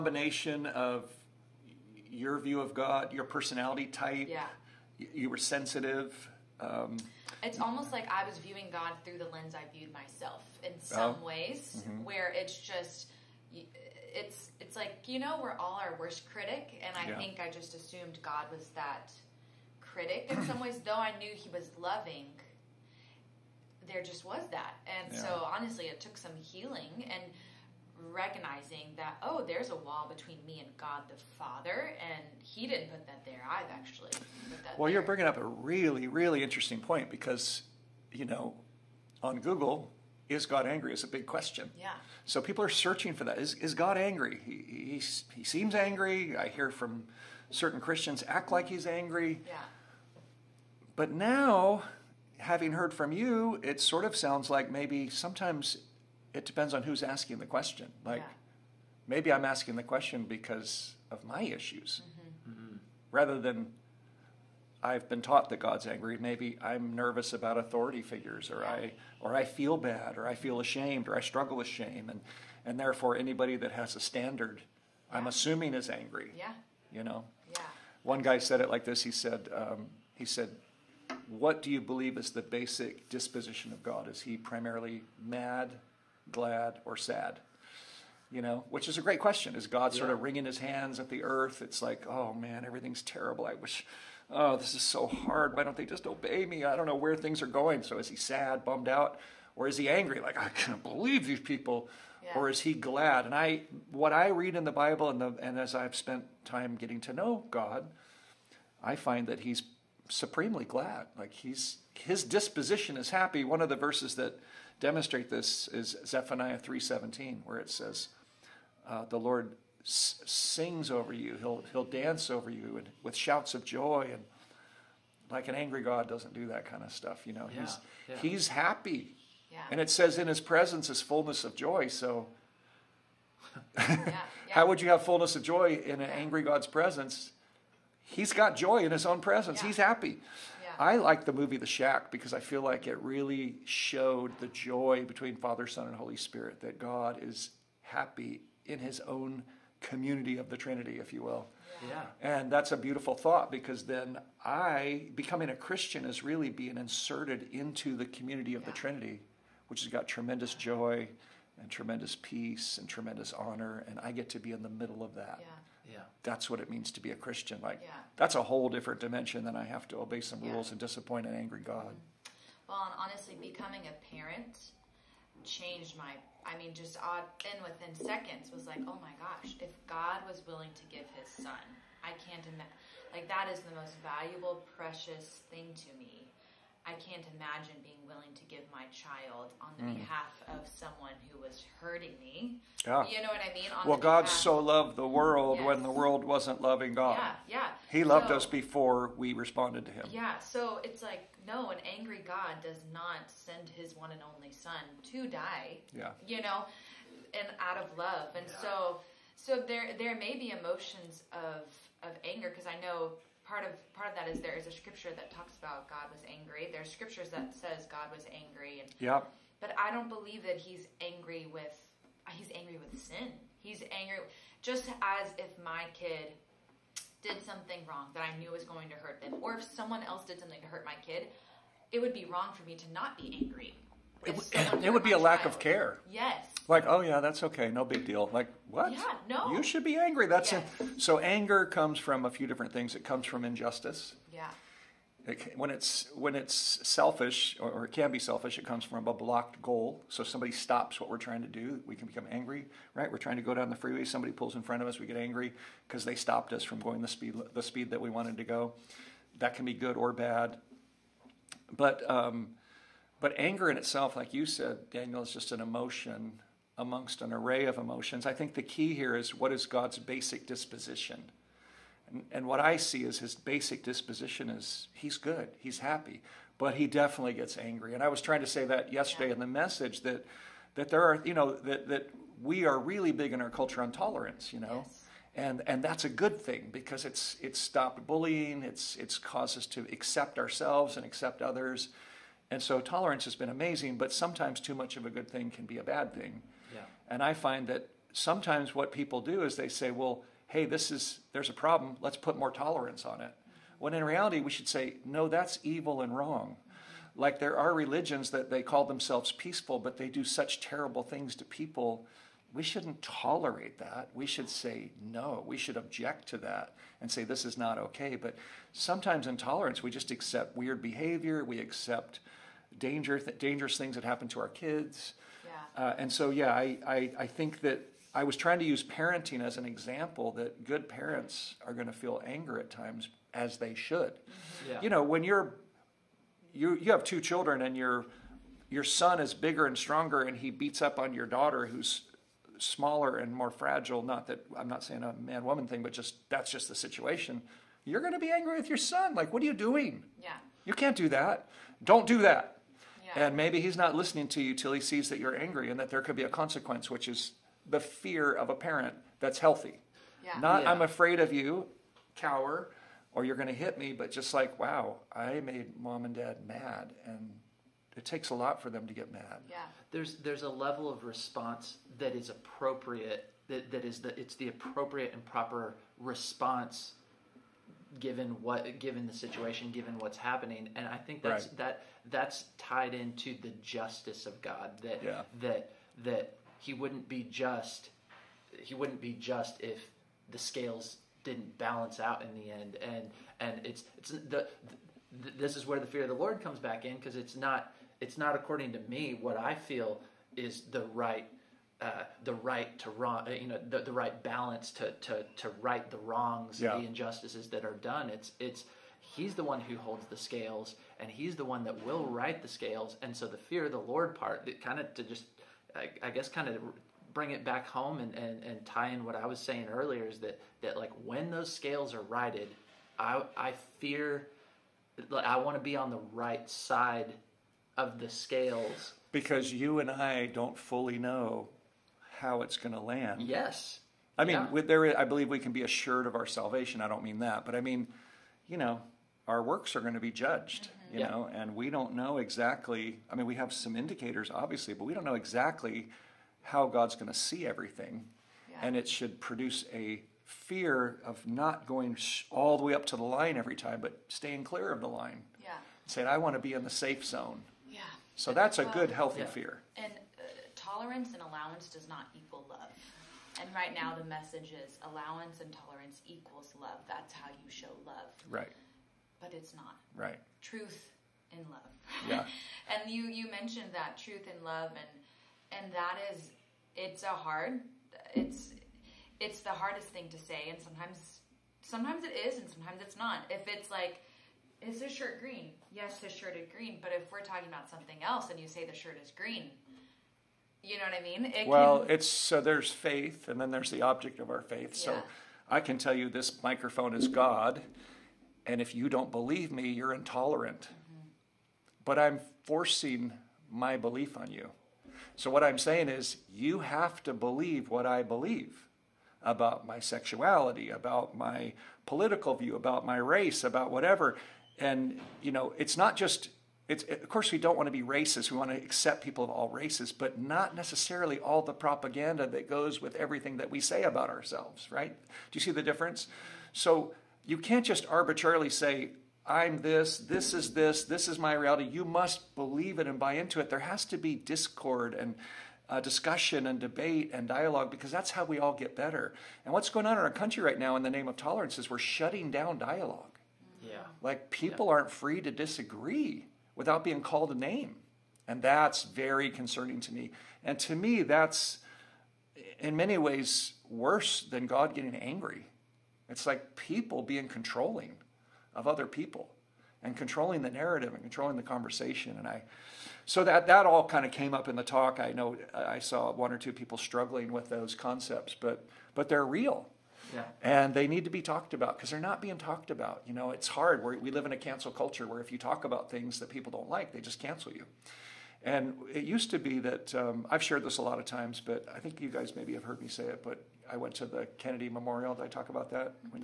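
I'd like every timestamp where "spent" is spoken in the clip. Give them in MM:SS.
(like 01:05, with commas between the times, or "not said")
01:45.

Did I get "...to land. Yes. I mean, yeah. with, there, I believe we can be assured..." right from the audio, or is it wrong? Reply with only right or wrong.
right.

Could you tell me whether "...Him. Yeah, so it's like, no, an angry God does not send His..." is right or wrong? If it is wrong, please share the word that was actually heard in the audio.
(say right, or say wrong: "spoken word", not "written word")
right.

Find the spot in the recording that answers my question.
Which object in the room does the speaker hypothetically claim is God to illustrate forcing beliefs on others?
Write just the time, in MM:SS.
08:16.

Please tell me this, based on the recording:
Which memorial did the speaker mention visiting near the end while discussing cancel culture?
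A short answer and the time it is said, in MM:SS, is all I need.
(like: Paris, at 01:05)
Kennedy Memorial, at 09:44.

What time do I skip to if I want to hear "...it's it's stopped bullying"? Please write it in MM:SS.
04:47.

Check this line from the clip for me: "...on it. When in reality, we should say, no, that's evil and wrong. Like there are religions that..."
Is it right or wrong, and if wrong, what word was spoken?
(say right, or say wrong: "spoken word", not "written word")
right.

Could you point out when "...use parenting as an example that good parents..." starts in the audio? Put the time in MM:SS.
05:28.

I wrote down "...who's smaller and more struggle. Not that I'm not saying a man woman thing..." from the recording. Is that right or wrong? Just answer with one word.
wrong.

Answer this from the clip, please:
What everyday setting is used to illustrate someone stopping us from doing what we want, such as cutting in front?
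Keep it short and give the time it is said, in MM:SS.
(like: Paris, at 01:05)
the freeway, at 04:13.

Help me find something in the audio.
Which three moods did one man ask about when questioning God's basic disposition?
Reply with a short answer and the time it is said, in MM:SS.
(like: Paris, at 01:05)
mad, glad, or sad, at 01:25.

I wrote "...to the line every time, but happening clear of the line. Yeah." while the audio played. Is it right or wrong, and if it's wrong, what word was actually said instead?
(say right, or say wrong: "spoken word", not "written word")
wrong: "staying", not "happening".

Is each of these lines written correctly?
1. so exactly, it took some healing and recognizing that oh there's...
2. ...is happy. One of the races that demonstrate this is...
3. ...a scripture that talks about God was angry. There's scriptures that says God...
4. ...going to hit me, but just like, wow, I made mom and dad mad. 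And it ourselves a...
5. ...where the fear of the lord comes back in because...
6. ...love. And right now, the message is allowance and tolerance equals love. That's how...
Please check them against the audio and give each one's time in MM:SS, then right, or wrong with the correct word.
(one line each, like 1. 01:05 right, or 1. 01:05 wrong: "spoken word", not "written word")
1. 00:25 wrong: "honestly", not "exactly"
2. 01:52 wrong: "verses", not "races"
3. 03:34 right
4. 06:03 wrong: "takes", not "ourselves"
5. 06:35 right
6. 07:42 right.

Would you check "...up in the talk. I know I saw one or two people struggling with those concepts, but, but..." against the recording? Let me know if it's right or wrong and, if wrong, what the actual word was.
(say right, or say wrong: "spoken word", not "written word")
right.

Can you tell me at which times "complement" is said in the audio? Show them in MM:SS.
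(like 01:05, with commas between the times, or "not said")
not said.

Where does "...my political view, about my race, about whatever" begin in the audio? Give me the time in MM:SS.
08:31.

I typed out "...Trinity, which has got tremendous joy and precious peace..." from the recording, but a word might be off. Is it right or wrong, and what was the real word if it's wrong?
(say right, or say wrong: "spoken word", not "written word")
wrong: "tremendous", not "precious".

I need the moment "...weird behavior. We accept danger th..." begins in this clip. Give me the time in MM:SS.
05:20.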